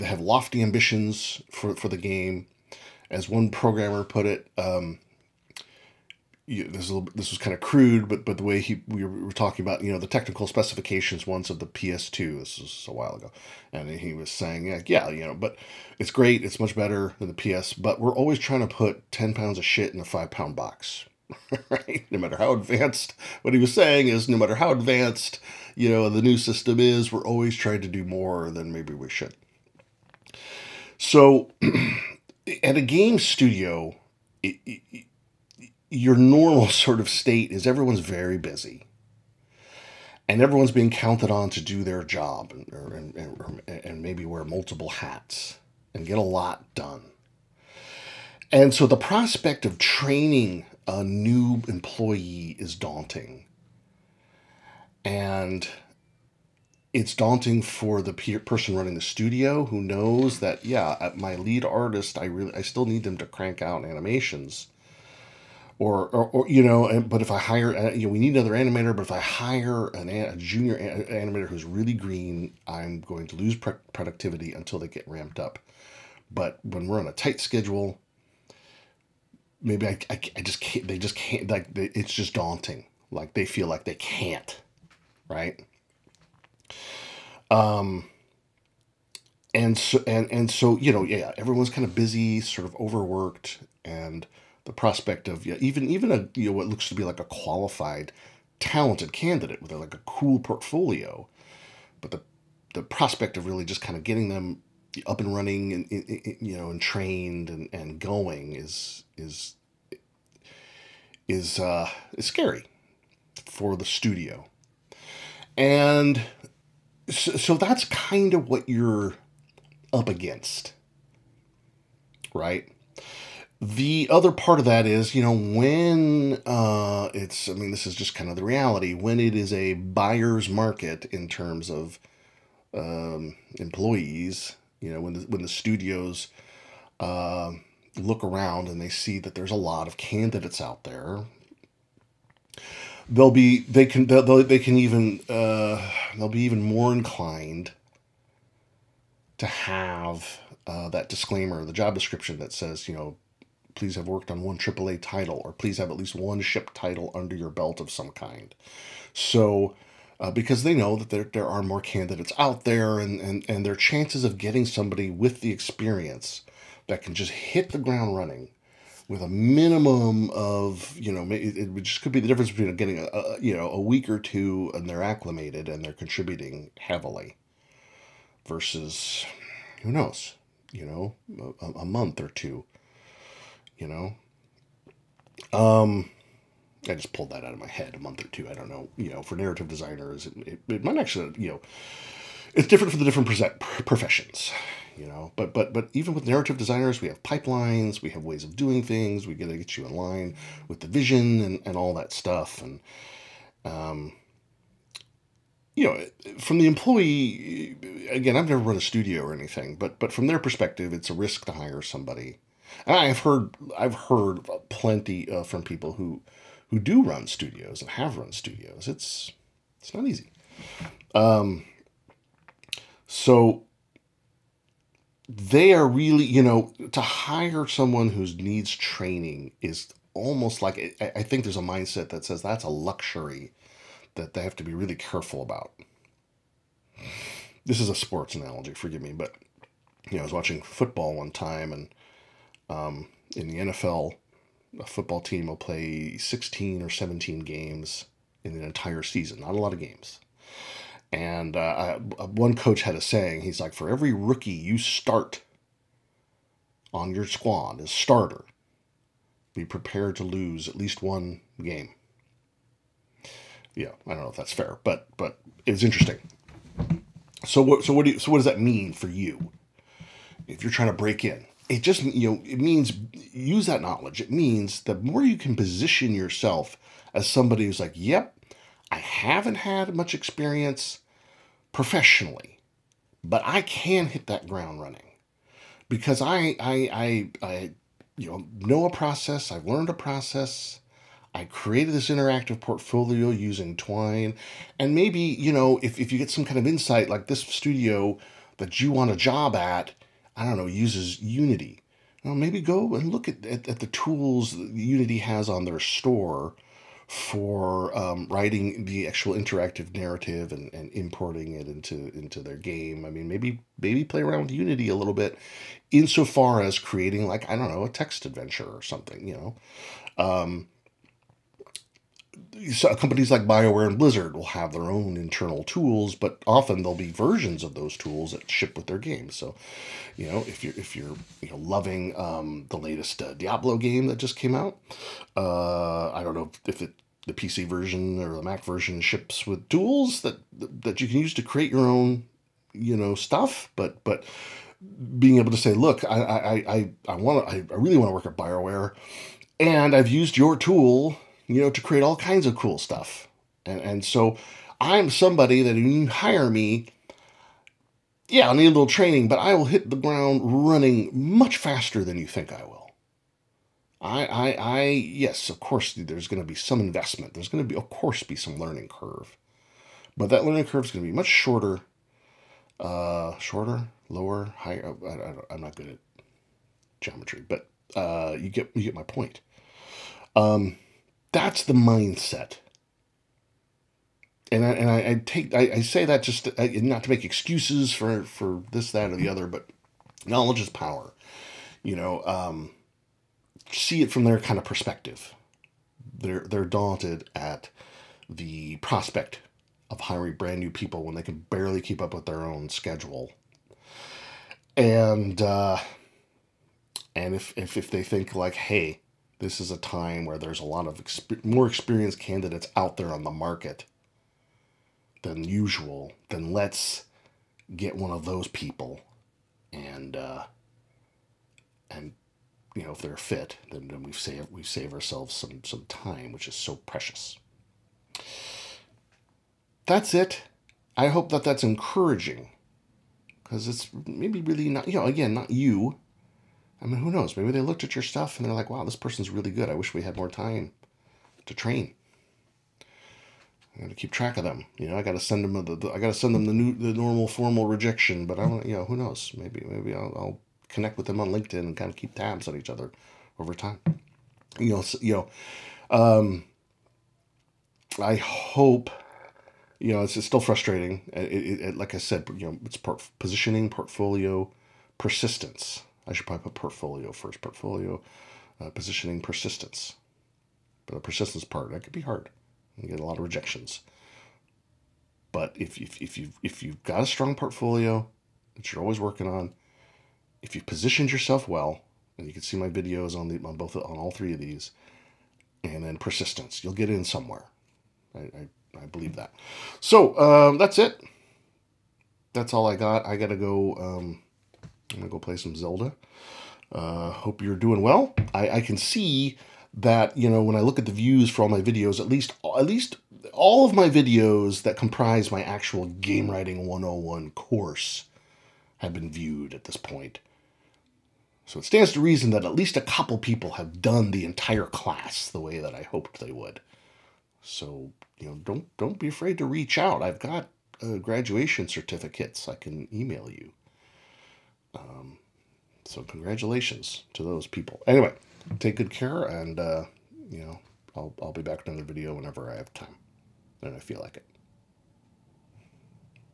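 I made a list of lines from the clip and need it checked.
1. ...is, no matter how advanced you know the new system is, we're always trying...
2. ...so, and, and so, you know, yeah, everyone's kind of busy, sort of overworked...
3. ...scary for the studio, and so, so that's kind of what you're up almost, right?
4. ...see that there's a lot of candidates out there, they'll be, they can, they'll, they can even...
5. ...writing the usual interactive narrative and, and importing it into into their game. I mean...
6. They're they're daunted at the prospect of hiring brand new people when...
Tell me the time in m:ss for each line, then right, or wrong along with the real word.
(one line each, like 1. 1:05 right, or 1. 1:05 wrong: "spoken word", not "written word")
1. 0:24 right
2. 1:29 right
3. 1:52 wrong: "against", not "almost"
4. 2:18 right
5. 5:08 wrong: "actual", not "usual"
6. 6:36 right.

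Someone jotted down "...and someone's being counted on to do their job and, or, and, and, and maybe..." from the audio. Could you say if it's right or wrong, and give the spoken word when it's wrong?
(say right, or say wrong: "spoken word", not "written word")
wrong: "everyone", not "someone".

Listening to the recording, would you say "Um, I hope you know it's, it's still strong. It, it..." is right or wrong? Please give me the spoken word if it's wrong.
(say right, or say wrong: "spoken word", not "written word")
wrong: "frustrating", not "strong".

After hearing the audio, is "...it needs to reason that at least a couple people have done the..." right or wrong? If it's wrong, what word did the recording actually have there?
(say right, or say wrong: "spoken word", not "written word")
wrong: "stands", not "needs".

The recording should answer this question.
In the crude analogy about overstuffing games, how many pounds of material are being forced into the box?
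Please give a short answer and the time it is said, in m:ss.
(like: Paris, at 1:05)
10 pounds, at 0:19.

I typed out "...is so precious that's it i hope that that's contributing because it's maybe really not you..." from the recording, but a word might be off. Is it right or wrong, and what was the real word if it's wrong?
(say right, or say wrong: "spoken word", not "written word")
wrong: "encouraging", not "contributing".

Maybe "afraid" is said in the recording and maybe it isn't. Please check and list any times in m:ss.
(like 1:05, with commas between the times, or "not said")
8:39.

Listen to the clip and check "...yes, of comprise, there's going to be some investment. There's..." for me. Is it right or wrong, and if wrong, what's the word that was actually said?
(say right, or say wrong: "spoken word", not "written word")
wrong: "course", not "comprise".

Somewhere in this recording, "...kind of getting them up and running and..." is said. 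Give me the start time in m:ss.
1:43.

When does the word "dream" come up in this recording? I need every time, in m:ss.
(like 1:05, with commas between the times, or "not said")
not said.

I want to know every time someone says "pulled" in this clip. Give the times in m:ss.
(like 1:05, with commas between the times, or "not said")
3:07.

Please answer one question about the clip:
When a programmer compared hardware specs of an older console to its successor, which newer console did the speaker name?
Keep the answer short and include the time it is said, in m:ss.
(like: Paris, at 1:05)
PS2, at 0:11.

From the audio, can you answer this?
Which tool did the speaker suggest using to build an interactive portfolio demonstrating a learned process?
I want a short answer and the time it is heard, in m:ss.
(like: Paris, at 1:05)
Twine, at 4:53.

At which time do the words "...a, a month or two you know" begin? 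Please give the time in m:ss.
3:01.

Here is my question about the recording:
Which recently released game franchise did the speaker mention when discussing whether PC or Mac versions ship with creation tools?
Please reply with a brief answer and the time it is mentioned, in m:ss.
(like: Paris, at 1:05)
Diablo, at 5:33.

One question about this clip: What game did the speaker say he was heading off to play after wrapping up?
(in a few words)
Zelda.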